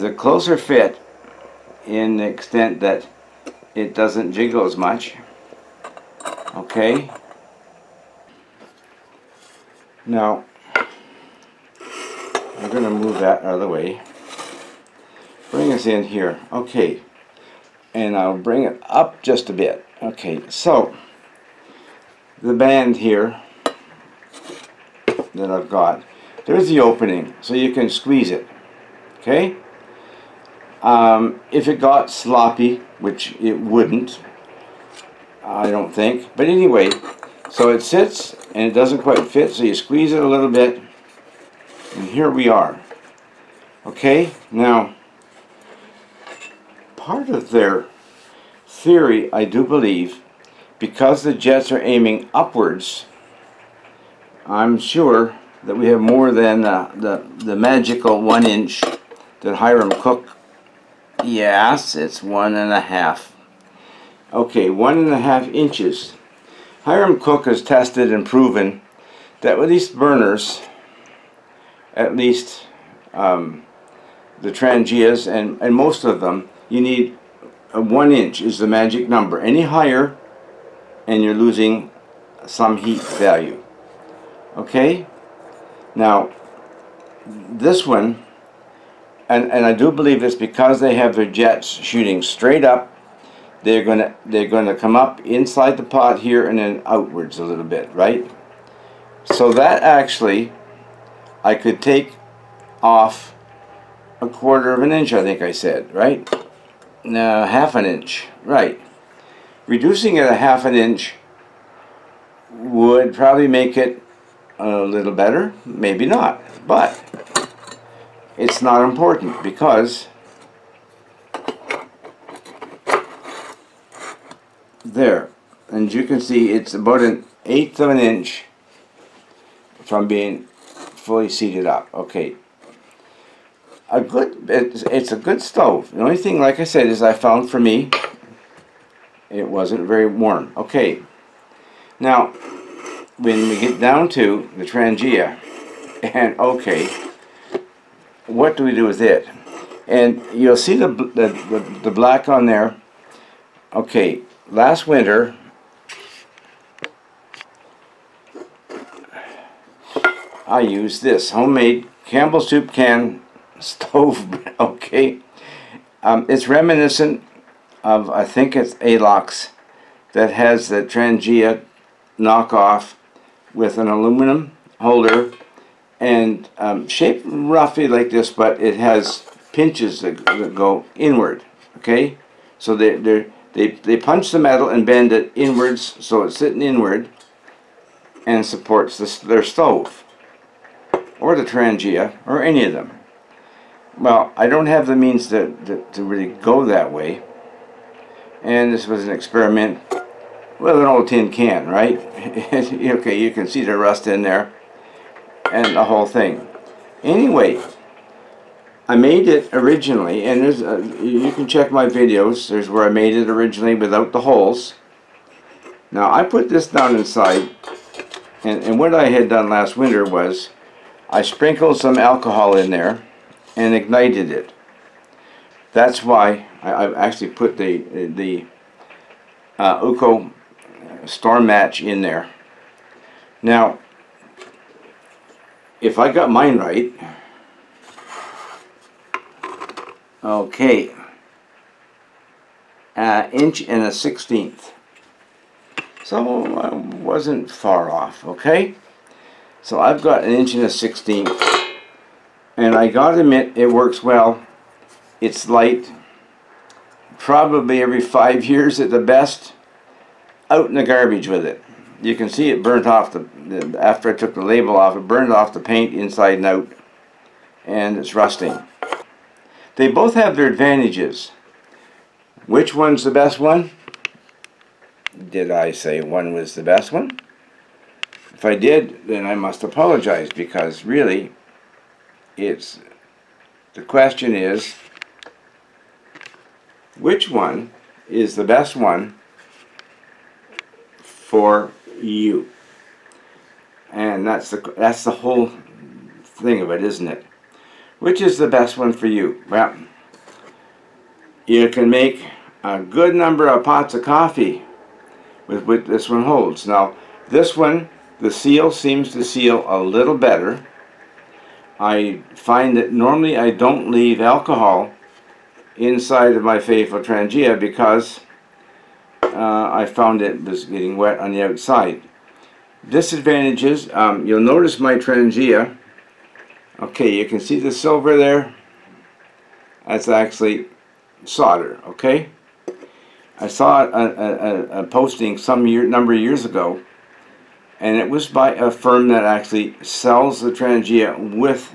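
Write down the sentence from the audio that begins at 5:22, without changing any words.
Disadvantages, um, you'll notice my Trangia.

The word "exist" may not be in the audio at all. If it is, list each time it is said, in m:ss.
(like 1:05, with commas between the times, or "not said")
not said.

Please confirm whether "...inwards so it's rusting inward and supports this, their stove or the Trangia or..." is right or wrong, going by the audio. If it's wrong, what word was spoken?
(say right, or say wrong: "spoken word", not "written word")
wrong: "sitting", not "rusting".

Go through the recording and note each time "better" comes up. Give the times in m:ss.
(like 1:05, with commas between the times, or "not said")
1:55, 5:10.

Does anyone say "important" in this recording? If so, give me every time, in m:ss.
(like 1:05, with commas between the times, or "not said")
1:58.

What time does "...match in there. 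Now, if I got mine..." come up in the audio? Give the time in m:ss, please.
3:51.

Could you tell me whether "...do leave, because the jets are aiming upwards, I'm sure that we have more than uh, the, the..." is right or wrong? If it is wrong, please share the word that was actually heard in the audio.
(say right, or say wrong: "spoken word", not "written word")
wrong: "believe", not "leave".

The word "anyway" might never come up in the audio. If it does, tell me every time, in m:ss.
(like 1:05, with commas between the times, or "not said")
0:36, 3:27.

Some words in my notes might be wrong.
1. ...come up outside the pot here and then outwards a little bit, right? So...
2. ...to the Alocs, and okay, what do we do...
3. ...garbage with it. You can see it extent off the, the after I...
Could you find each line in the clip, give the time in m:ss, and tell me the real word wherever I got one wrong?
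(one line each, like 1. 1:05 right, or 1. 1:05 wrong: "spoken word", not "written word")
1. 1:34 wrong: "inside", not "outside"
2. 2:24 wrong: "Trangia", not "Alocs"
3. 4:20 wrong: "burnt", not "extent".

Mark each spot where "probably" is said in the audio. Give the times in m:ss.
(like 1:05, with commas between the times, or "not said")
1:53, 4:17.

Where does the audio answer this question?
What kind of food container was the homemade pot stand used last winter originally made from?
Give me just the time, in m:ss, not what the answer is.
2:42.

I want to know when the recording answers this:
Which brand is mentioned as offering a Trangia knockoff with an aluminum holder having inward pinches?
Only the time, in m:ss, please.
2:48.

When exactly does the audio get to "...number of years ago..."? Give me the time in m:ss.
5:35.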